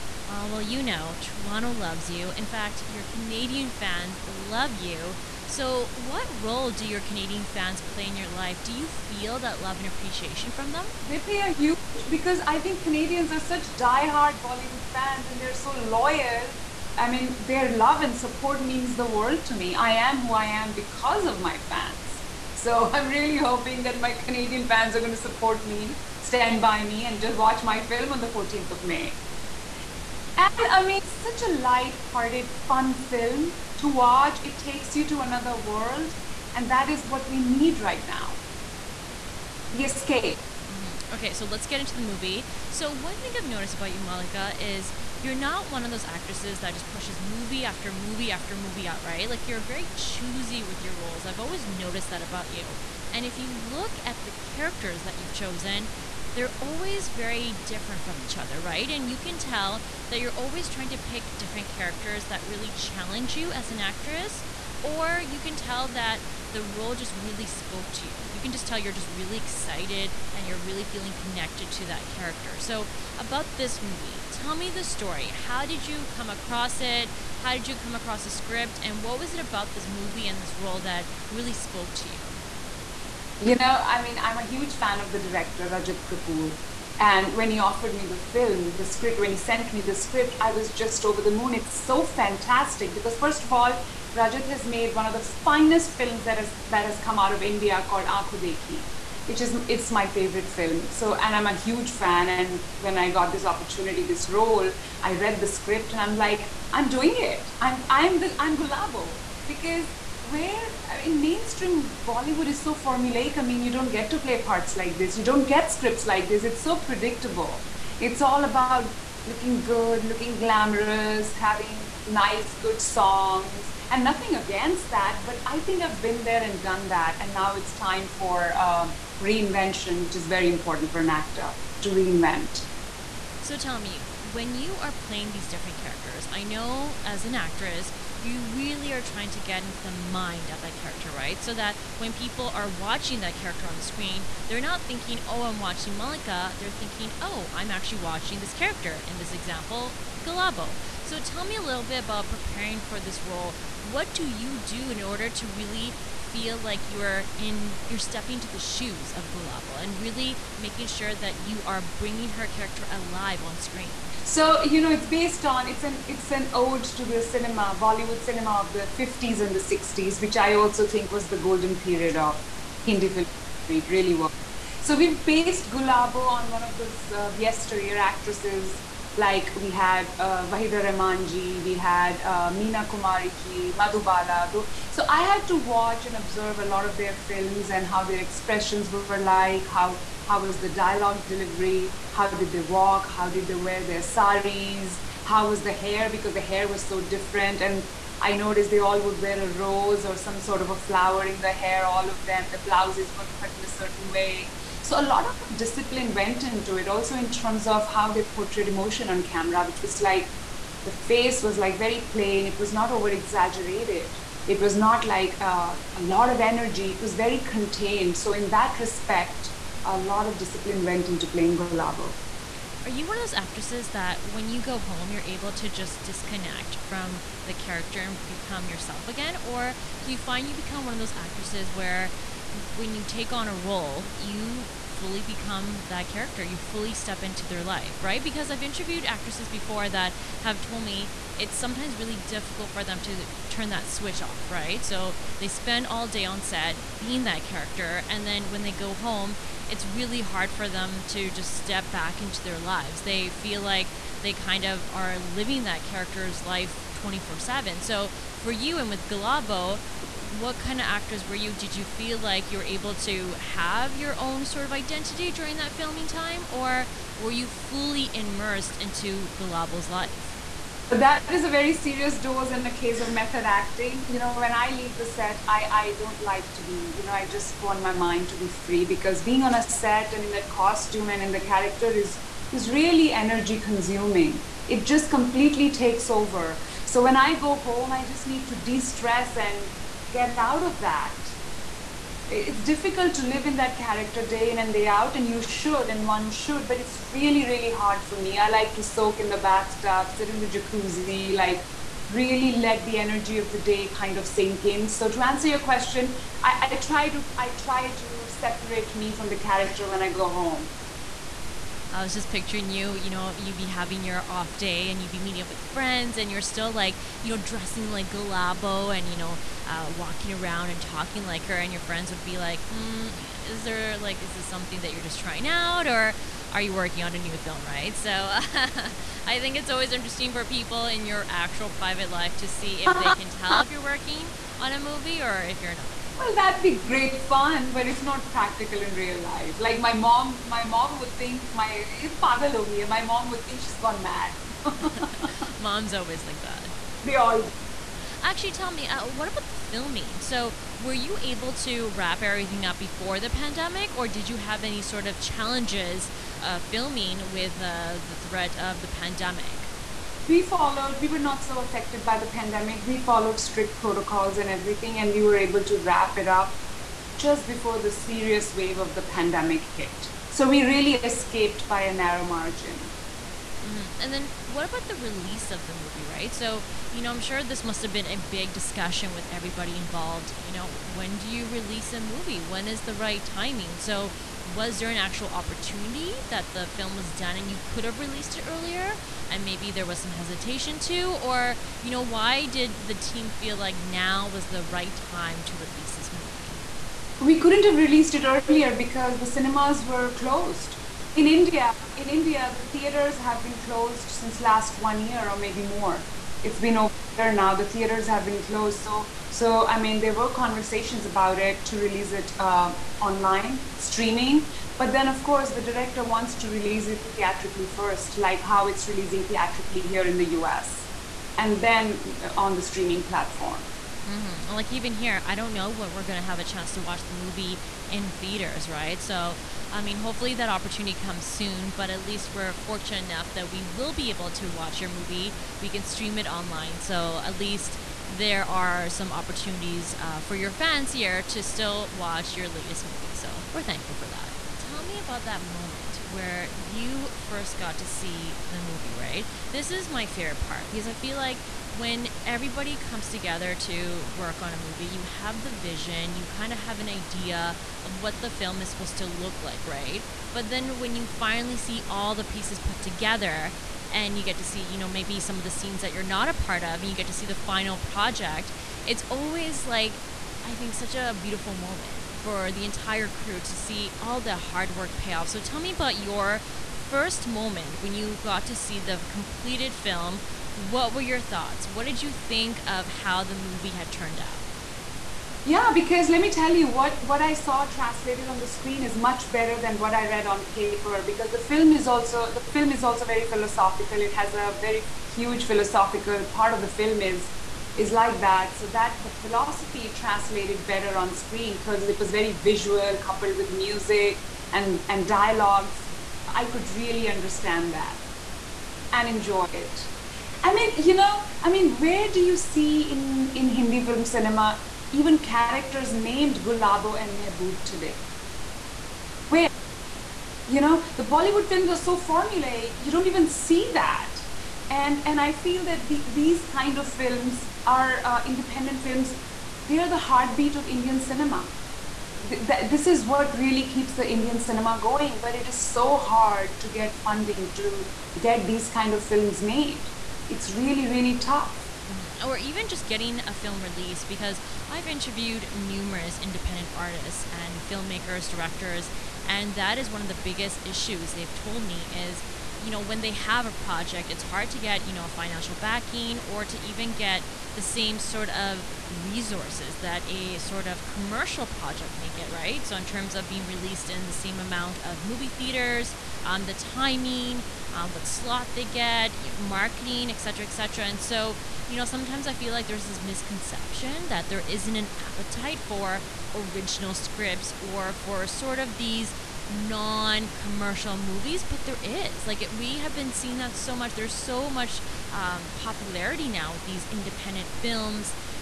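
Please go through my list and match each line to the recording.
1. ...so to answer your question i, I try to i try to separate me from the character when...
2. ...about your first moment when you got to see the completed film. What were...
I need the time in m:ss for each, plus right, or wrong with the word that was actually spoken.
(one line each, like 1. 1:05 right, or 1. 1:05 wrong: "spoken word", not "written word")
1. 5:04 right
2. 7:55 right.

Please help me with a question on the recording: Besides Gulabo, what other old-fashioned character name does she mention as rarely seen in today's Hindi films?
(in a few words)
Mehboob.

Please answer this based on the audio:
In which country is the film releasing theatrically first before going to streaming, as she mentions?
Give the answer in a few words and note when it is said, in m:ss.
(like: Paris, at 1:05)
US, at 7:00.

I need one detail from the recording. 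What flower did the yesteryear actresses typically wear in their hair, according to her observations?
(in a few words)
Rose.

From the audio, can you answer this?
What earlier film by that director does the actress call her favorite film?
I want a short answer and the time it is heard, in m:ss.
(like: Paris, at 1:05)
Ankhon Dekhi, at 1:38.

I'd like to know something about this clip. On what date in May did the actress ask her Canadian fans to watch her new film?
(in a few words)
14th of May.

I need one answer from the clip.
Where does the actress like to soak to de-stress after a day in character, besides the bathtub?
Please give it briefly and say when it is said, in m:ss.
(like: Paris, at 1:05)
Jacuzzi, at 5:00.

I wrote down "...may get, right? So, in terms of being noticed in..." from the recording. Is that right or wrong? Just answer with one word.
wrong.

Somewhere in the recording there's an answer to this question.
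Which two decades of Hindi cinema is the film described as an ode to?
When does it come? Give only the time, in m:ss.
2:48.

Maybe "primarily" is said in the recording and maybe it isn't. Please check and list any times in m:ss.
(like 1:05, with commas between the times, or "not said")
not said.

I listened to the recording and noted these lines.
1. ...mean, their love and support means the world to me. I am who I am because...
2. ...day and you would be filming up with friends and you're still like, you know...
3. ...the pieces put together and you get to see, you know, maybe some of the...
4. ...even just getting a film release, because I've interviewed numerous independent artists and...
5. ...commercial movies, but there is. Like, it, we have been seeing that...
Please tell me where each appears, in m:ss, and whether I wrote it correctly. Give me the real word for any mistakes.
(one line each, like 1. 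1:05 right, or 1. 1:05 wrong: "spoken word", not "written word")
1. 0:17 right
2. 5:14 wrong: "meeting", not "filming"
3. 7:42 right
4. 9:02 right
5. 9:40 right.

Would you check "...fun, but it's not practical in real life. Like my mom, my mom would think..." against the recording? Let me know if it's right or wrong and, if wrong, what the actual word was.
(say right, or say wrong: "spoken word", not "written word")
right.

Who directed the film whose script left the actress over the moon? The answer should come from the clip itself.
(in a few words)
Rajat Kapoor.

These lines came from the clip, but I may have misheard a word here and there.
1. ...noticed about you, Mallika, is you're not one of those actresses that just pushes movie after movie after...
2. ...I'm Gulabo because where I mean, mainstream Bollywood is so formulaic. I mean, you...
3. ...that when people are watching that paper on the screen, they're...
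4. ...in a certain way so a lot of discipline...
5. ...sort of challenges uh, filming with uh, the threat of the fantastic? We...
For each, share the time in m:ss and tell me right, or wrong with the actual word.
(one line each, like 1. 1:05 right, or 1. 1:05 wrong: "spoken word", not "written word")
1. 0:43 right
2. 1:48 right
3. 2:21 wrong: "character", not "paper"
4. 3:23 right
5. 5:54 wrong: "pandemic", not "fantastic".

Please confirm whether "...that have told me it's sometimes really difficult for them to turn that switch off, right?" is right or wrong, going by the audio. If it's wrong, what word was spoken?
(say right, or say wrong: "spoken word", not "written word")
right.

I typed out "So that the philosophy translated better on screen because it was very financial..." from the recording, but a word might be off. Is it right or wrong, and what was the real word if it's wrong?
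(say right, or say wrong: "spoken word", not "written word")
wrong: "visual", not "financial".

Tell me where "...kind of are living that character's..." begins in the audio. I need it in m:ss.
4:14.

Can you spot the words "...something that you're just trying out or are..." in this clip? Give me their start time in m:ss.
5:24.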